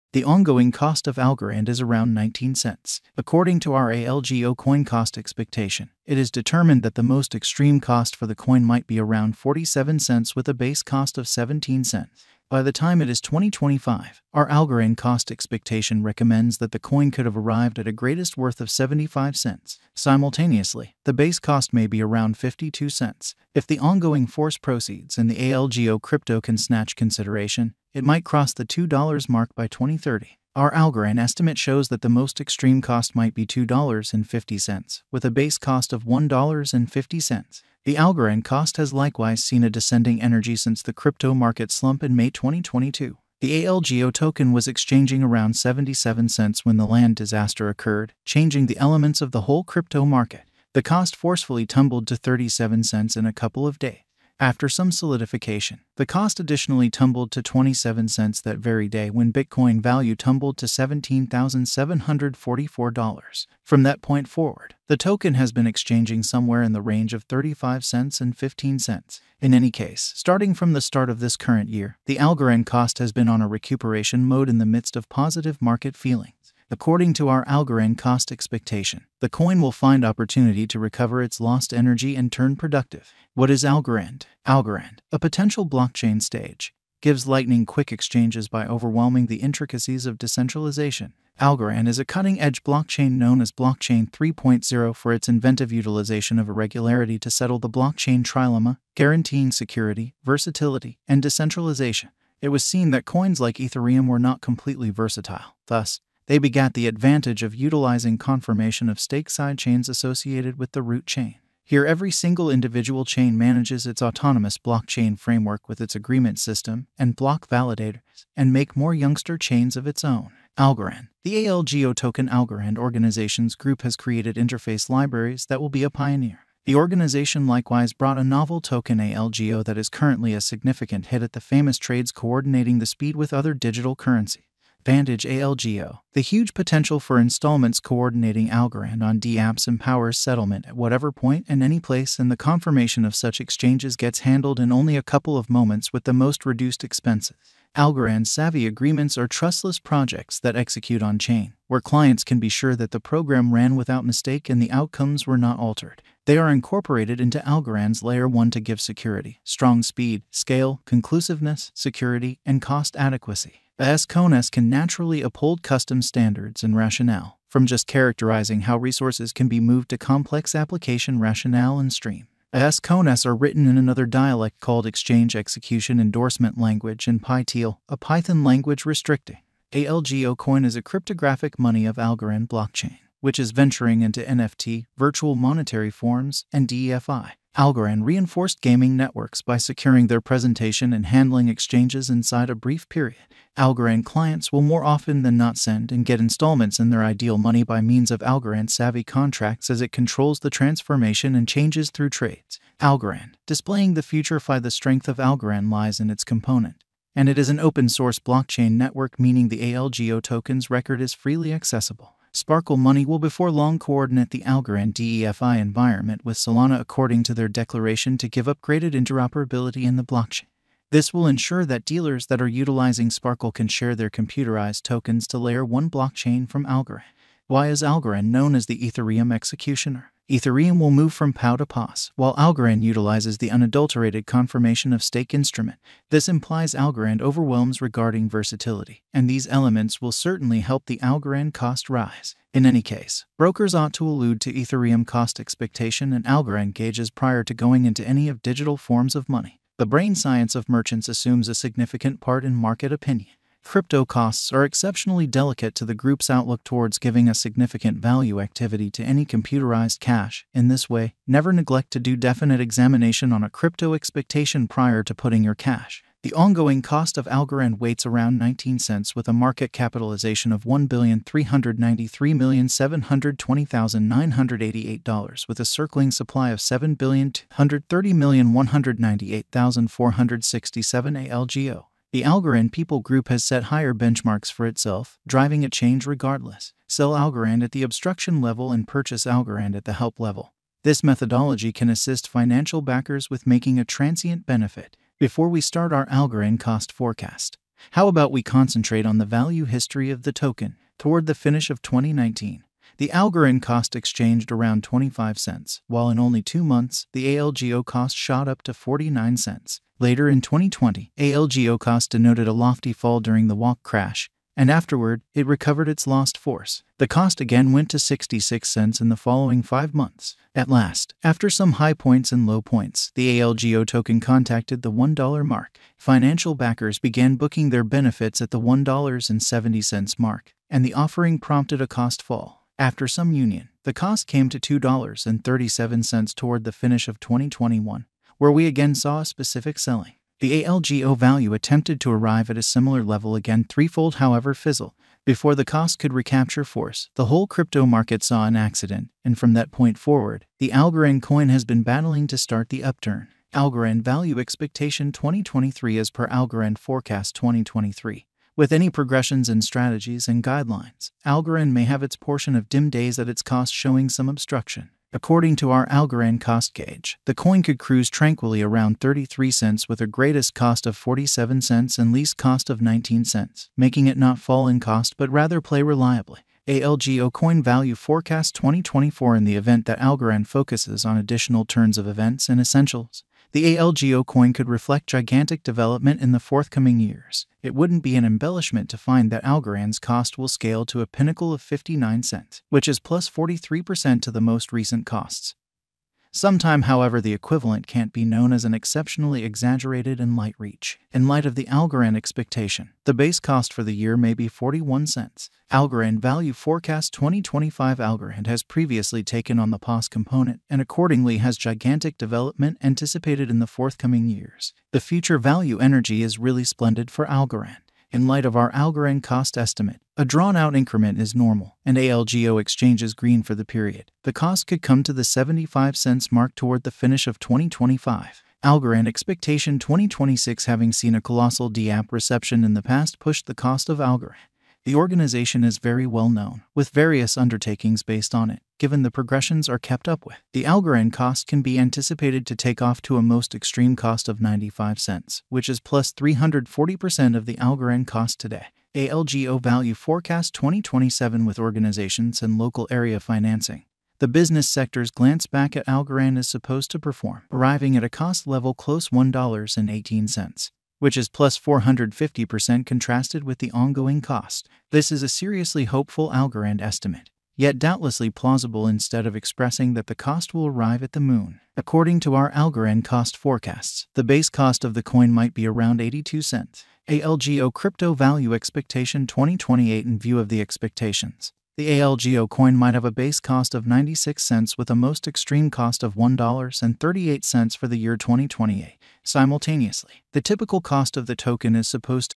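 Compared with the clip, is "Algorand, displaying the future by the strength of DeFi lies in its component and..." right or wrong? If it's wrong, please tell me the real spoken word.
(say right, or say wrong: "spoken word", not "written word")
wrong: "Algorand", not "DeFi".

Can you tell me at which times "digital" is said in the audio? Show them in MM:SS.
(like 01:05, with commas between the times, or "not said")
02:13, 04:08.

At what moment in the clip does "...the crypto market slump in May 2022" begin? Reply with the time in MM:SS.
00:40.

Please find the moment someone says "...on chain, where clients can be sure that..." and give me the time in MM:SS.
02:31.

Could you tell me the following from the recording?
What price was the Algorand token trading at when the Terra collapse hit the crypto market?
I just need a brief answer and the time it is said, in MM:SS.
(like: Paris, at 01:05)
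77 cents, at 00:45.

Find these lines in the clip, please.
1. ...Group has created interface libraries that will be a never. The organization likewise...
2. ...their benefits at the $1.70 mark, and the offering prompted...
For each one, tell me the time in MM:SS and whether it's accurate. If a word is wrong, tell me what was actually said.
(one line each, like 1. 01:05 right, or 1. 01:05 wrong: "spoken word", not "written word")
1. 02:03 wrong: "pioneer", not "never"
2. 05:27 right.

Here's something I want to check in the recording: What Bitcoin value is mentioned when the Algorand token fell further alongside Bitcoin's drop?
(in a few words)
$17,744.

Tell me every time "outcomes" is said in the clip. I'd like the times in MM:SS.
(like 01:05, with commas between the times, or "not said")
02:34.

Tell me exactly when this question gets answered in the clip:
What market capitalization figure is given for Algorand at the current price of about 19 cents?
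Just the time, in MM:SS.
04:30.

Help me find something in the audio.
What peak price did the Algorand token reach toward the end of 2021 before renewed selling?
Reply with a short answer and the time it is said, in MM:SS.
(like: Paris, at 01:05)
$2.37, at 05:34.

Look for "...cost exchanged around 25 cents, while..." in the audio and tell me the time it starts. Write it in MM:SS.
05:03.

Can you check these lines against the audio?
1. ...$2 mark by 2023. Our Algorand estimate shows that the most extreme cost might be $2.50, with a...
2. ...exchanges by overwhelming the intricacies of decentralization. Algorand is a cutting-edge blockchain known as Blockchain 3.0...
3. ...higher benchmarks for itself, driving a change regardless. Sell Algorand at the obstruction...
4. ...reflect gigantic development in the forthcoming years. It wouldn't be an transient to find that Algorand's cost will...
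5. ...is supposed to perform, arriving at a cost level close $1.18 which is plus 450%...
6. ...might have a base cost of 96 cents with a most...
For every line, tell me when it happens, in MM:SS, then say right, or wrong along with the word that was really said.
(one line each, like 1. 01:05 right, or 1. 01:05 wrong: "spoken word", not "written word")
1. 00:28 wrong: "2030", not "2023"
2. 01:27 right
3. 04:43 right
4. 06:24 wrong: "embellishment", not "transient"
5. 07:36 right
6. 08:02 right.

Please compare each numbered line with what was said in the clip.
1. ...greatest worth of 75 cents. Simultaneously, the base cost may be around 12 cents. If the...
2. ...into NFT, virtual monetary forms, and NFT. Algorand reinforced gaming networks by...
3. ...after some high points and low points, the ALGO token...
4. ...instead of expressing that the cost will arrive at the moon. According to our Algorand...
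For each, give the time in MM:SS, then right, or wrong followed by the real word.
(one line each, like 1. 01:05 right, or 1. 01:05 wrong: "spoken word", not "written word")
1. 00:17 wrong: "52", not "12"
2. 03:04 wrong: "DeFi", not "NFT"
3. 05:21 right
4. 07:48 right.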